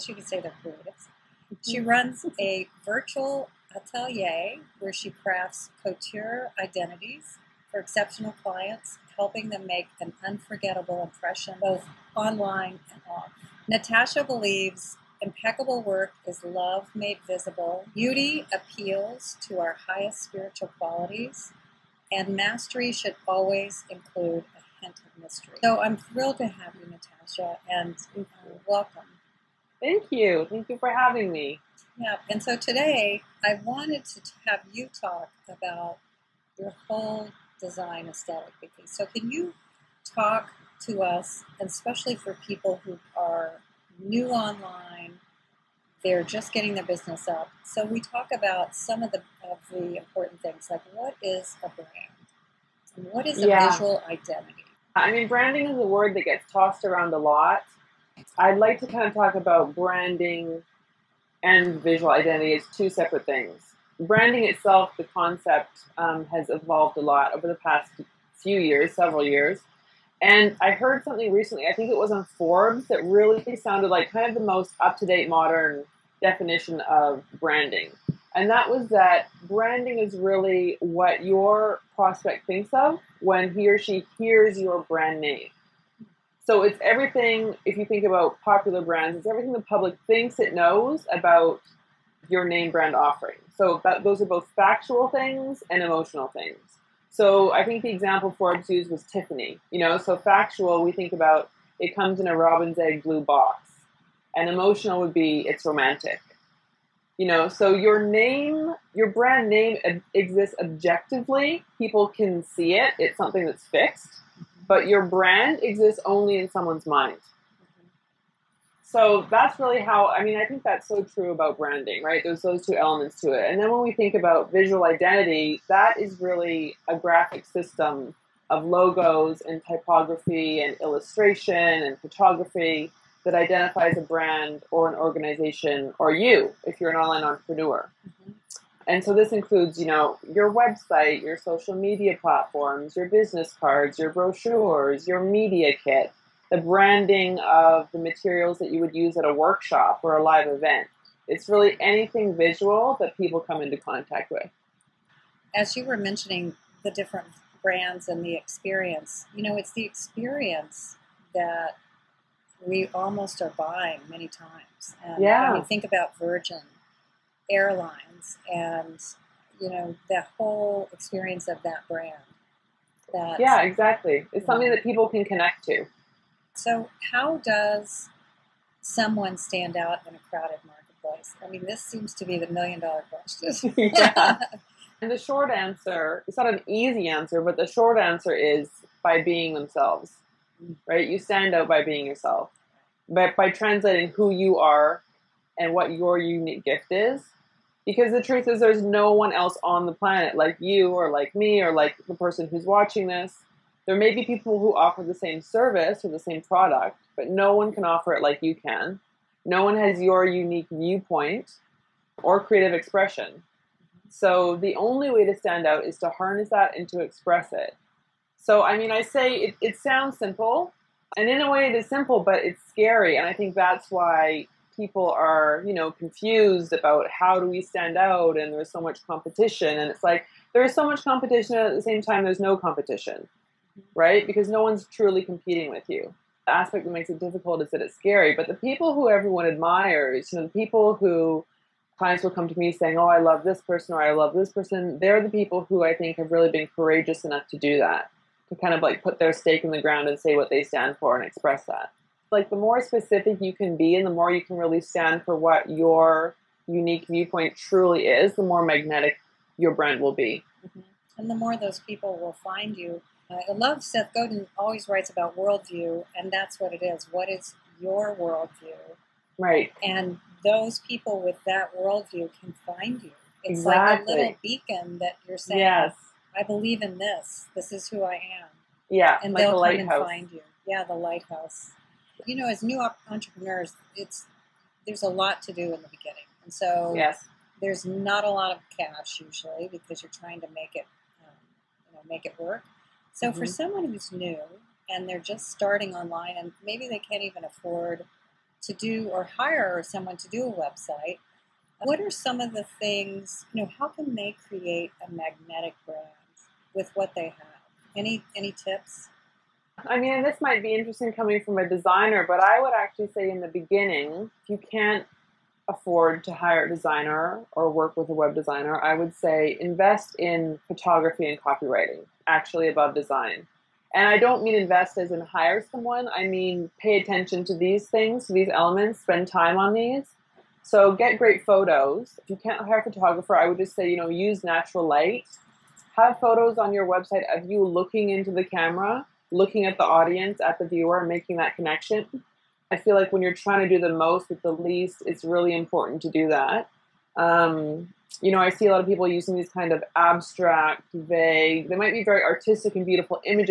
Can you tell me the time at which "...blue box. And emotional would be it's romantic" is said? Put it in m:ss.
1:43.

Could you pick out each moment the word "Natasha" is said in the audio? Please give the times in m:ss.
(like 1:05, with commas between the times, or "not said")
0:13, 0:26.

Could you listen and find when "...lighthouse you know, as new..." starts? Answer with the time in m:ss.
4:40.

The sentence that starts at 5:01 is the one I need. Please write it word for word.
What are some of the things, you know, how can they create a magnetic brand with what they have?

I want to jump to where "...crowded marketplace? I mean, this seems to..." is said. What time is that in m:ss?
3:00.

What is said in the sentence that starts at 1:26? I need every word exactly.
So it's everything, if you think about popular brands, it's everything the public thinks it knows about your name brand offering.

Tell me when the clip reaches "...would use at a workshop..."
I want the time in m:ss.
2:28.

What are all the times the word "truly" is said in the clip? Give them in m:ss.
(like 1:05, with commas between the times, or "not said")
3:54, 4:17.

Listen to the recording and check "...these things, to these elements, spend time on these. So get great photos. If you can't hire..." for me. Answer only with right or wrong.
right.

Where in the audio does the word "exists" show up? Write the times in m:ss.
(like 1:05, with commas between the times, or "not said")
1:50, 1:55.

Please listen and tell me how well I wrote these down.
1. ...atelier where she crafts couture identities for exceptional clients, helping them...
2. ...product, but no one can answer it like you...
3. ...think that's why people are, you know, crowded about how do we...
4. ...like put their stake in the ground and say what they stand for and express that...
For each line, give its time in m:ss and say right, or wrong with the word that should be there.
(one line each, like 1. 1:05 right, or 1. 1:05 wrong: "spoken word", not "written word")
1. 0:03 right
2. 3:26 wrong: "offer", not "answer"
3. 3:43 wrong: "confused", not "crowded"
4. 4:08 right.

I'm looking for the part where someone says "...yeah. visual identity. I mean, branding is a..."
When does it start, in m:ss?
0:53.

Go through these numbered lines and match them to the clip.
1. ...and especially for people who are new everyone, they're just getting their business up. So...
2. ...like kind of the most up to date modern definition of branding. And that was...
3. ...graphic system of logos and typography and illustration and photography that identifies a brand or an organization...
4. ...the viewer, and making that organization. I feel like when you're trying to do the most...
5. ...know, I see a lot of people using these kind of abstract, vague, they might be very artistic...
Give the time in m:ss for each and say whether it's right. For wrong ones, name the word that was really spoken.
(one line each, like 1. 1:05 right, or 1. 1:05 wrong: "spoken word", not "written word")
1. 0:41 wrong: "online", not "everyone"
2. 1:13 right
3. 2:06 right
4. 5:40 wrong: "connection", not "organization"
5. 5:48 right.